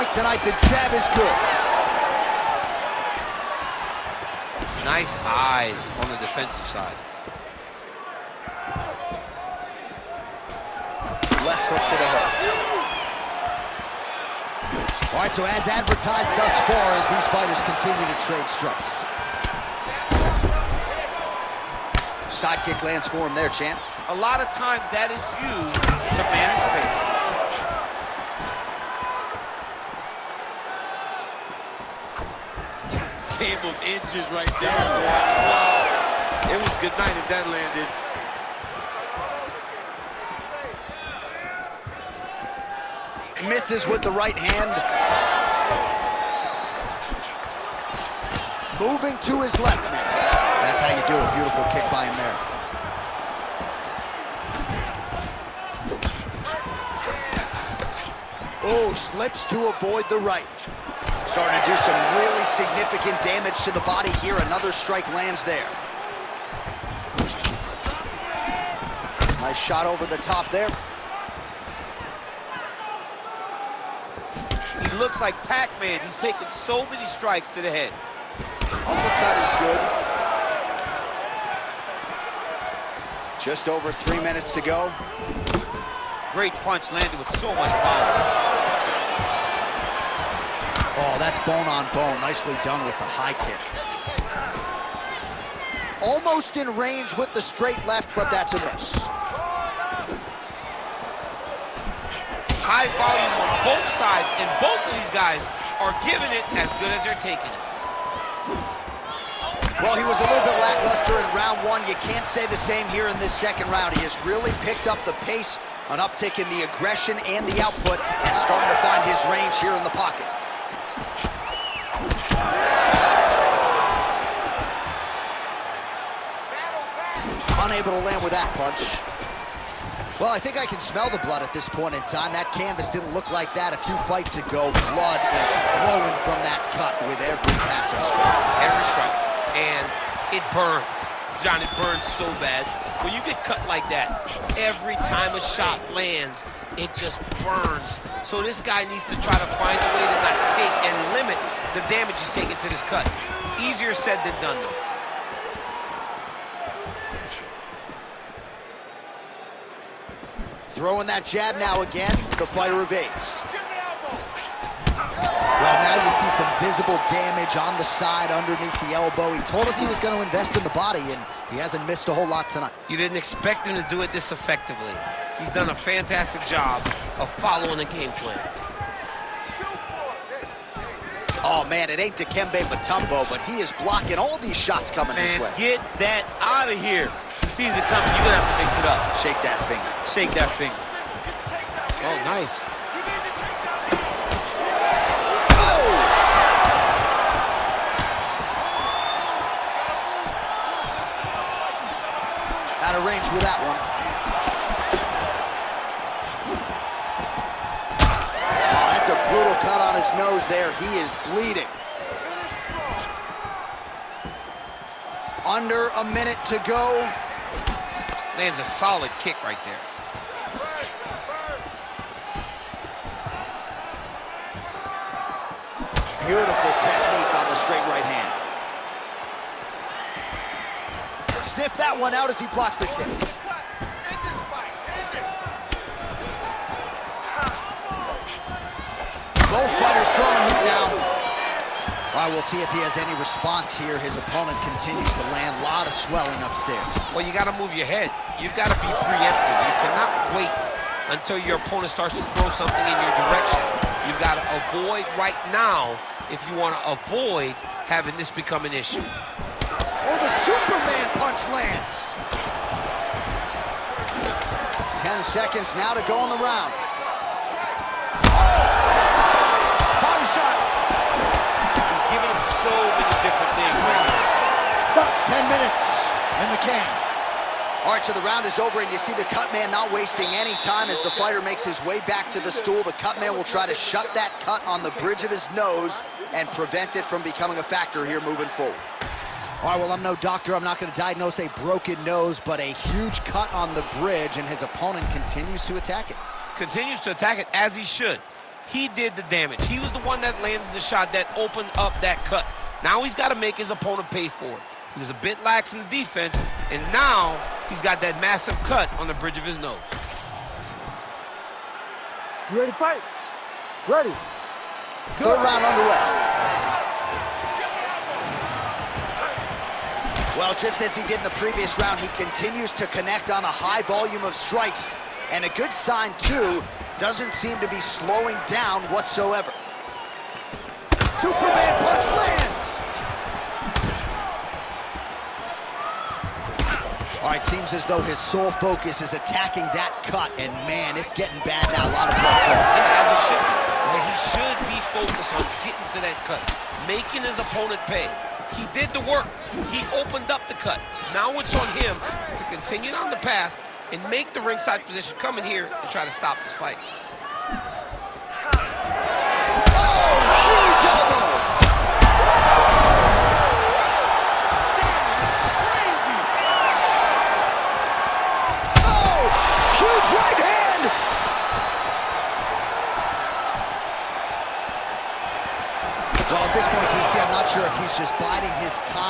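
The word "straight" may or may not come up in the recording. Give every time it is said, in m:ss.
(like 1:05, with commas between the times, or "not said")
1:37, 3:47.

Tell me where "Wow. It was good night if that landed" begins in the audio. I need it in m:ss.
0:34.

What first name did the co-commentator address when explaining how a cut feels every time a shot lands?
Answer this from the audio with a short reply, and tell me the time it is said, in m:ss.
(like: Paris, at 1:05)
Jon, at 2:21.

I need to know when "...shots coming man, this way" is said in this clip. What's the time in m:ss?
3:04.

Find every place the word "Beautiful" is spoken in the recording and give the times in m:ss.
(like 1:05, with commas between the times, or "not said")
0:51, 3:46.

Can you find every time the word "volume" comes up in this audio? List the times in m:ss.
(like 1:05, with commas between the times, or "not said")
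1:42, 5:23.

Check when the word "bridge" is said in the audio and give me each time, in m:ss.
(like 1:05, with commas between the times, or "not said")
4:44, 4:53, 5:09.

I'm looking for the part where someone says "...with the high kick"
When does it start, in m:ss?
1:32.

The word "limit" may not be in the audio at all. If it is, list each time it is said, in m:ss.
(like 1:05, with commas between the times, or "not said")
2:31.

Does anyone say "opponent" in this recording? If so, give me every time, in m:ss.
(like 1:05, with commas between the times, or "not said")
4:04, 4:11, 4:54, 5:03, 5:47.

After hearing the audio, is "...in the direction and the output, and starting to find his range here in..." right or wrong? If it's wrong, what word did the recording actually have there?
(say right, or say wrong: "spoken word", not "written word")
wrong: "aggression", not "direction".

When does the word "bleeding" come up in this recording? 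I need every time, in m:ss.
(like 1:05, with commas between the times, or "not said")
3:31.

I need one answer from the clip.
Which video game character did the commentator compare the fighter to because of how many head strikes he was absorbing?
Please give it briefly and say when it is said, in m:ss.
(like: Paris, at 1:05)
Pac-Man, at 1:15.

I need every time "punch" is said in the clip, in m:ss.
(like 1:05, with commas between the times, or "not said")
1:26, 2:08, 4:21, 5:31.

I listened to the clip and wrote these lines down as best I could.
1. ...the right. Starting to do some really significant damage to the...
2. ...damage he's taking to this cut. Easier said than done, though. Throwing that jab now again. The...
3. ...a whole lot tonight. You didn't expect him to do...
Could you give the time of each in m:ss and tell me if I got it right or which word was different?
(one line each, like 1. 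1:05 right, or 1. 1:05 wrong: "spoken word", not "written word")
1. 1:00 right
2. 2:31 right
3. 2:52 right.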